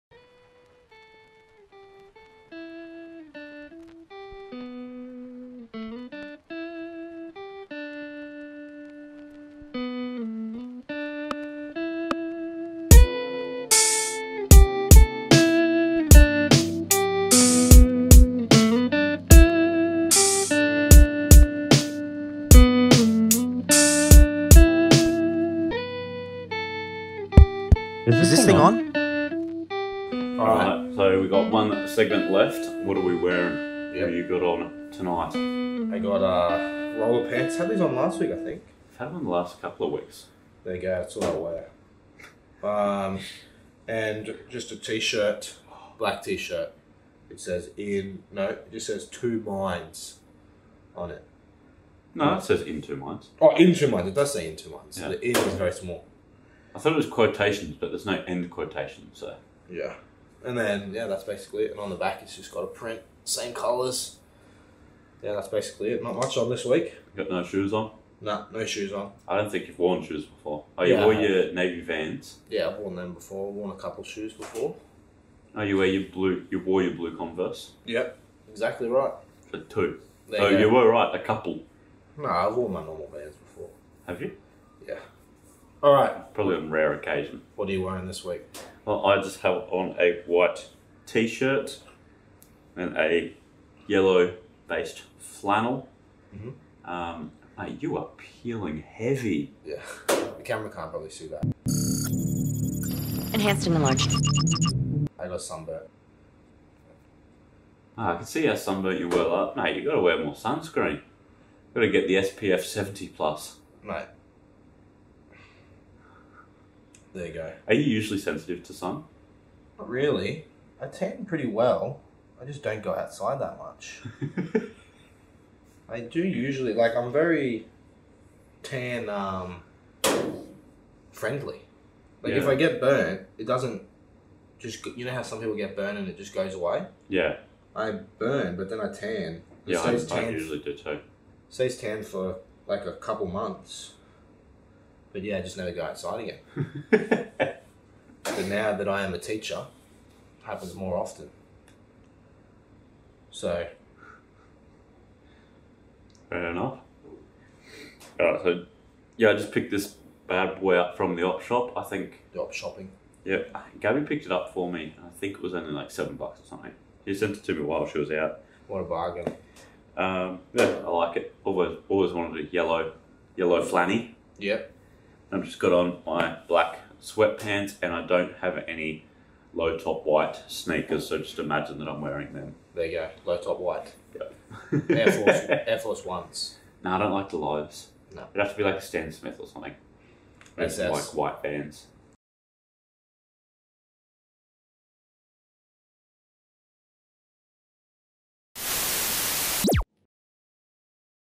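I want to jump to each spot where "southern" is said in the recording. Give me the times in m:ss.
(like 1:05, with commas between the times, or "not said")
not said.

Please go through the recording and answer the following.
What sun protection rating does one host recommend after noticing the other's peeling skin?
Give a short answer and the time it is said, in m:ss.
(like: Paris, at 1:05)
SPF 70 plus, at 1:52.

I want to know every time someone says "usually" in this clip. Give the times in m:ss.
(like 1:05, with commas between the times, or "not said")
1:57, 2:06, 2:20.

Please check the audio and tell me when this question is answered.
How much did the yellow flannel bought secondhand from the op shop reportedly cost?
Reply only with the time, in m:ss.
2:45.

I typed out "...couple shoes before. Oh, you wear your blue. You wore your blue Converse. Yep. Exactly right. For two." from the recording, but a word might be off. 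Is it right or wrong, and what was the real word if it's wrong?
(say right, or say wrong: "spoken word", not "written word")
right.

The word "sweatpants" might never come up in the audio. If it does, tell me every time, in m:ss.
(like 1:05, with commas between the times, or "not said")
2:57.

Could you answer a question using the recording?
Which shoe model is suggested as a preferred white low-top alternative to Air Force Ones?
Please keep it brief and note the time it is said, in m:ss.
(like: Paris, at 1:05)
Stan Smith, at 3:08.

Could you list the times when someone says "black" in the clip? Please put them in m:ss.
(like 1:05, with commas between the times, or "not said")
0:45, 2:56.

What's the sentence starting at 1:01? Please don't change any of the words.
And on the back, it's just got a print, same colours.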